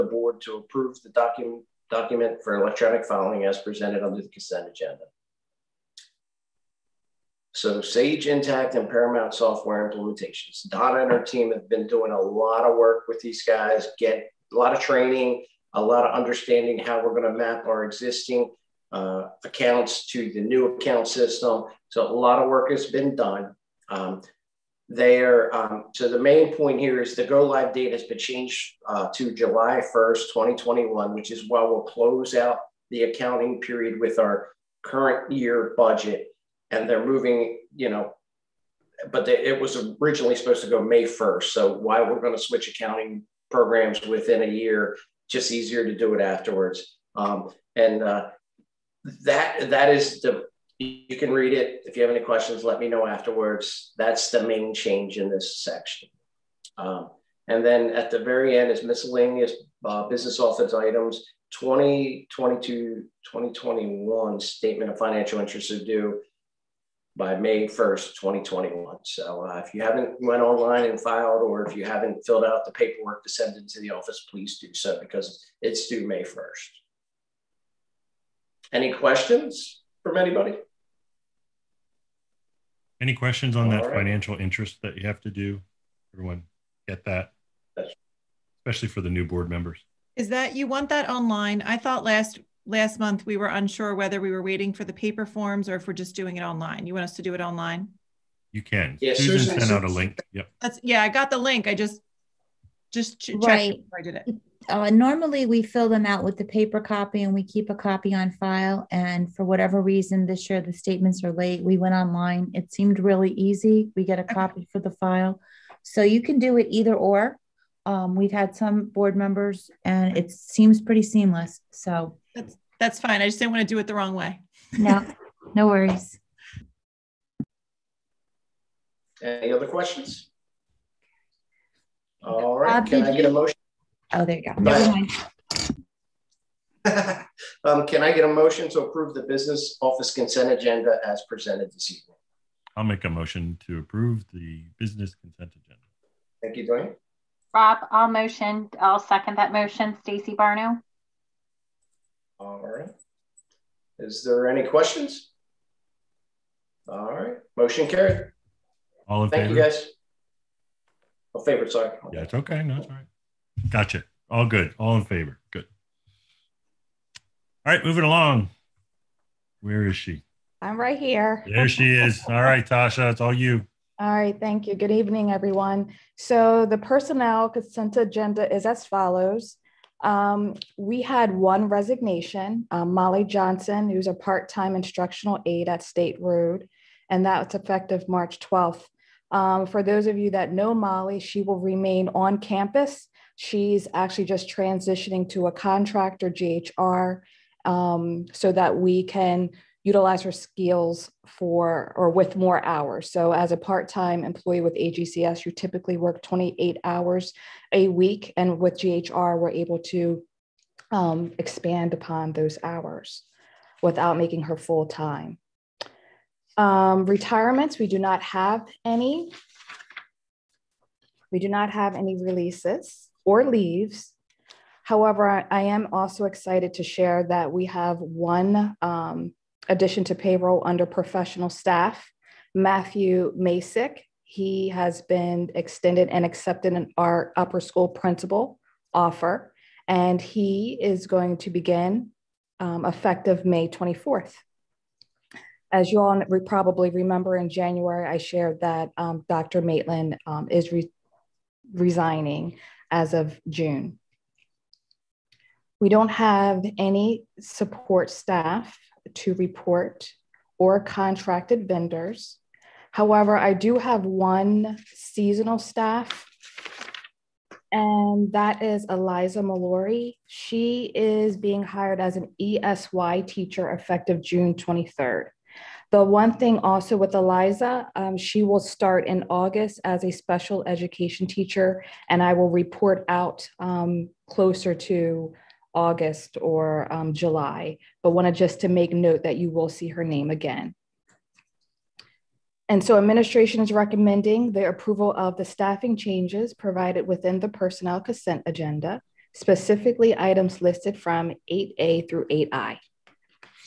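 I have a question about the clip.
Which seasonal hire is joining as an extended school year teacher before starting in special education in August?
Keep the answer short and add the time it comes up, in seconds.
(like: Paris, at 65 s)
Eliza Mallory, at 268 s.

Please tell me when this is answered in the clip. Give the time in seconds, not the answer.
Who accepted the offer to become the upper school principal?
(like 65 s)
232 s.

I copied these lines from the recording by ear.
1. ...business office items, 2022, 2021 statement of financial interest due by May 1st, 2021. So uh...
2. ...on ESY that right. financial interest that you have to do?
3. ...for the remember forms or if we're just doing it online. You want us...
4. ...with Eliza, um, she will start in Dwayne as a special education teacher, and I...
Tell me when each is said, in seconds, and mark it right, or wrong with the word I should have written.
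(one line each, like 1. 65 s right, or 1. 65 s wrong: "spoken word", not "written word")
1. 60 s right
2. 83 s wrong: "All", not "ESY"
3. 94 s wrong: "paper", not "remember"
4. 276 s wrong: "August", not "Dwayne".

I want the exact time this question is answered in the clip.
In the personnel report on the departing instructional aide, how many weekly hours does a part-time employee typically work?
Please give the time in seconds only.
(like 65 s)
206 s.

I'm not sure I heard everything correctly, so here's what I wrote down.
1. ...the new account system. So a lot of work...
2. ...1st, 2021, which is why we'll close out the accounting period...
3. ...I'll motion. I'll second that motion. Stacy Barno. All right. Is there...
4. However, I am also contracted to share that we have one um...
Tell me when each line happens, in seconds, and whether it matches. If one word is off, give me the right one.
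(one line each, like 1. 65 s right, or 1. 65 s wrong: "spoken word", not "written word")
1. 20 s right
2. 29 s right
3. 147 s right
4. 224 s wrong: "excited", not "contracted".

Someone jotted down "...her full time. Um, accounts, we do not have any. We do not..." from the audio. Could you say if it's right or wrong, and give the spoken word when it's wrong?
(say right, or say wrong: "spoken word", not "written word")
wrong: "retirements", not "accounts".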